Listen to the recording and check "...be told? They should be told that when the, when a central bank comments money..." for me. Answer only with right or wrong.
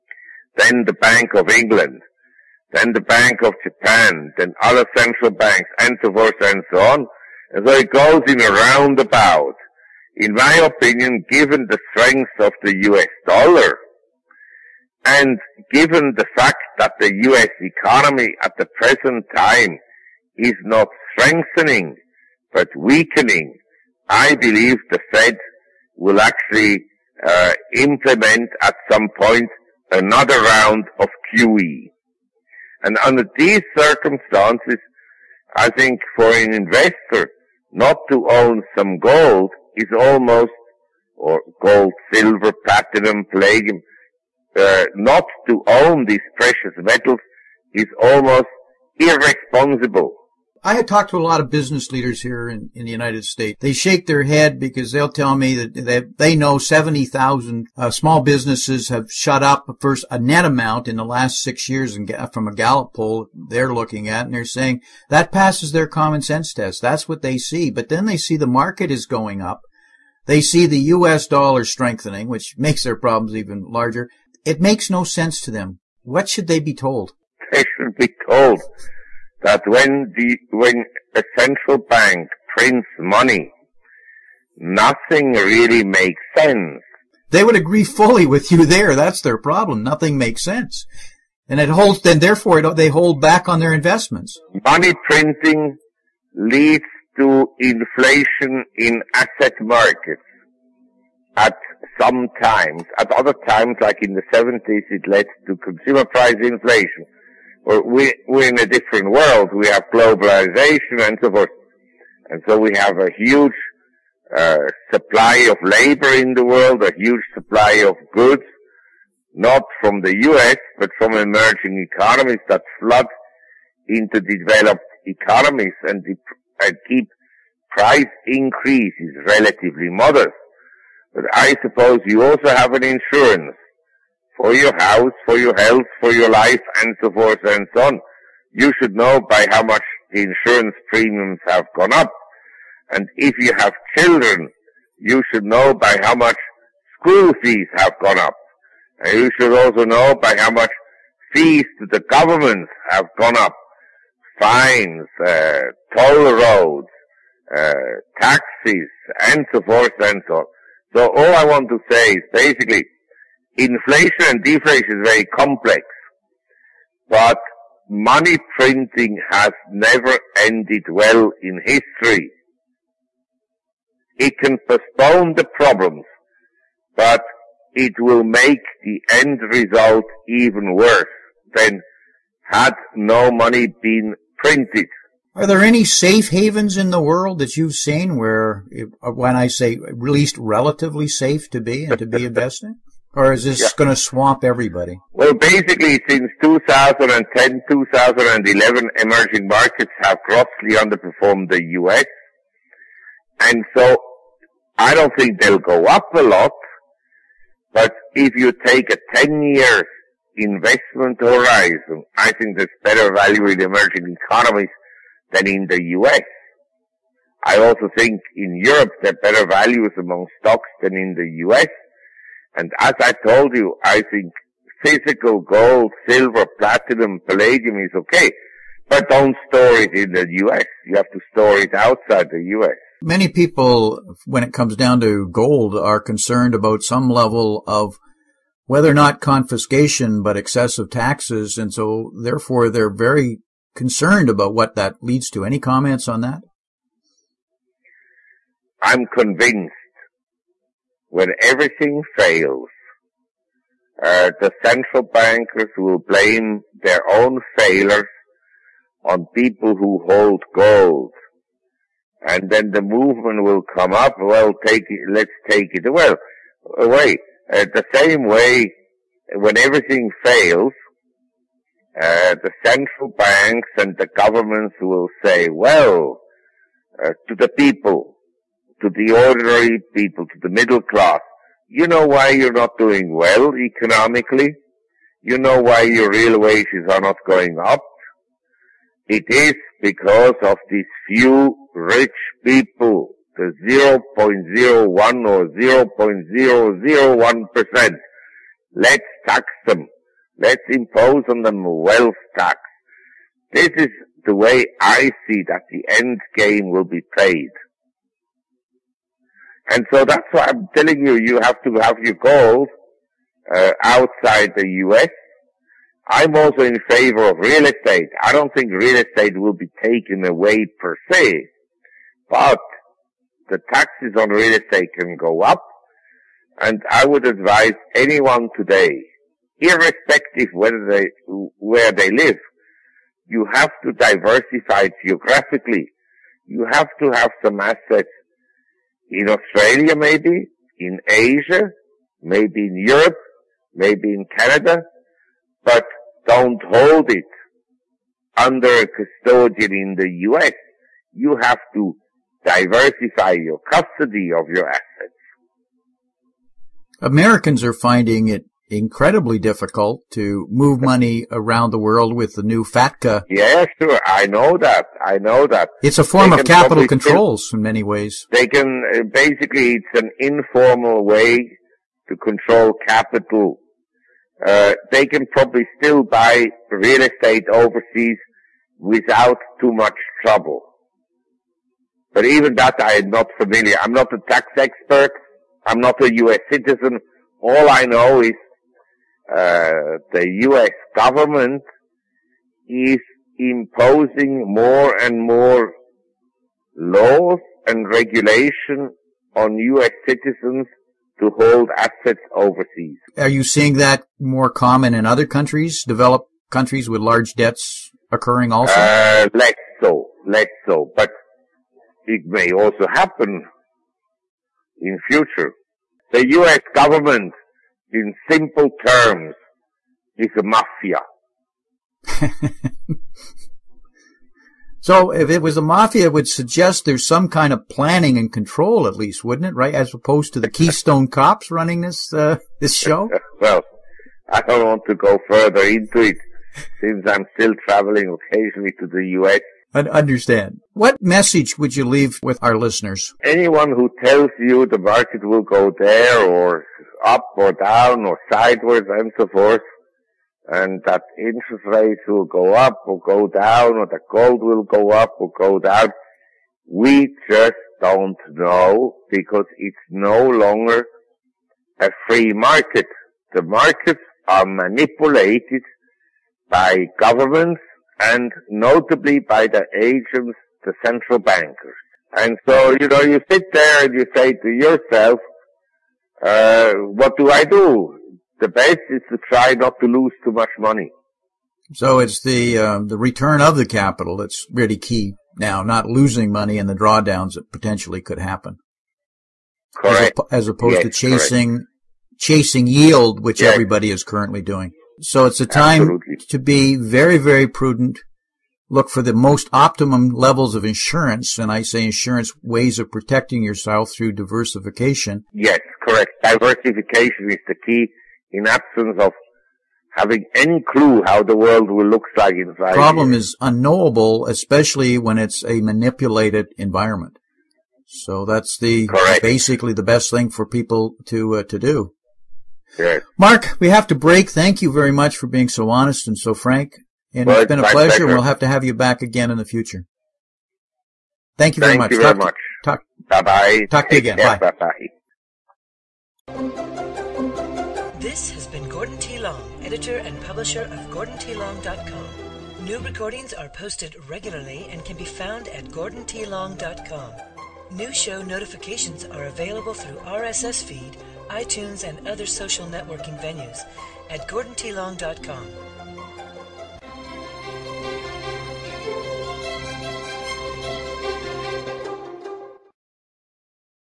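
wrong.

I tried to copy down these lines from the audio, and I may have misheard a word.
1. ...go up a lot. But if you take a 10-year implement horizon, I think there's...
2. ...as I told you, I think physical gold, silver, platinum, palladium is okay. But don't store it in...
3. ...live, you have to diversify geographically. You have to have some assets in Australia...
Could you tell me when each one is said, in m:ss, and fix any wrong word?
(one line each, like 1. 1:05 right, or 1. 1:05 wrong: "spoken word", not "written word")
1. 3:25 wrong: "investment", not "implement"
2. 3:42 right
3. 5:32 right.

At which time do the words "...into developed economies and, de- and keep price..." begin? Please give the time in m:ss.
2:03.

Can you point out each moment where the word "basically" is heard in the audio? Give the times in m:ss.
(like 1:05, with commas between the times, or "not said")
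2:42, 3:15, 6:09, 8:39.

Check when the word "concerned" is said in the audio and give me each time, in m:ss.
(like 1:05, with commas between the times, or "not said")
3:55, 4:03.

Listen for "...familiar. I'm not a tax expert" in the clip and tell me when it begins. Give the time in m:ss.
6:23.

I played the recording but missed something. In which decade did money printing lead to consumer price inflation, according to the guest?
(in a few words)
the 70s.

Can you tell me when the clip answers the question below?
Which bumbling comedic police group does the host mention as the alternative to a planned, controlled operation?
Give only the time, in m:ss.
7:10.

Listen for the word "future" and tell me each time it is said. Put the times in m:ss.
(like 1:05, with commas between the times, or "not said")
6:55, 8:49.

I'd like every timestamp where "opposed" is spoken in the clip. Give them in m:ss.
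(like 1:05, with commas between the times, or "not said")
7:09, 8:10.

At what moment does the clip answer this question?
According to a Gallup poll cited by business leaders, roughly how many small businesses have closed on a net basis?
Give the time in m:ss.
0:56.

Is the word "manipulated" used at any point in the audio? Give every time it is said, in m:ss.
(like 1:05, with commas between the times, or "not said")
7:44, 8:35.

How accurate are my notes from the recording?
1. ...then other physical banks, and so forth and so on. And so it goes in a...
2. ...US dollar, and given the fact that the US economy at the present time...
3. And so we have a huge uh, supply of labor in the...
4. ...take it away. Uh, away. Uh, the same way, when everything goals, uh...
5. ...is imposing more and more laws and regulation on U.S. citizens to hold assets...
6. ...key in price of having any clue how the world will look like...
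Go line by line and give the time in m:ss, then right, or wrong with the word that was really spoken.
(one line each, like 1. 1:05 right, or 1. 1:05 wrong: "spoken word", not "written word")
1. 0:04 wrong: "central", not "physical"
2. 0:12 right
3. 1:52 right
4. 4:25 wrong: "fails", not "goals"
5. 6:32 right
6. 8:27 wrong: "absence", not "price".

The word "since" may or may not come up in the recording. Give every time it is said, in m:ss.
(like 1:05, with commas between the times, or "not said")
3:16, 7:16.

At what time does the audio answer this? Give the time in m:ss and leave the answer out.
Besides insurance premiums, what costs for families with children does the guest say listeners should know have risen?
2:26.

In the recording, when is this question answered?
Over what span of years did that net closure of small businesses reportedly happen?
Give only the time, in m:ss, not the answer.
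1:01.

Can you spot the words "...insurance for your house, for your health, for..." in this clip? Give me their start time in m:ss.
2:12.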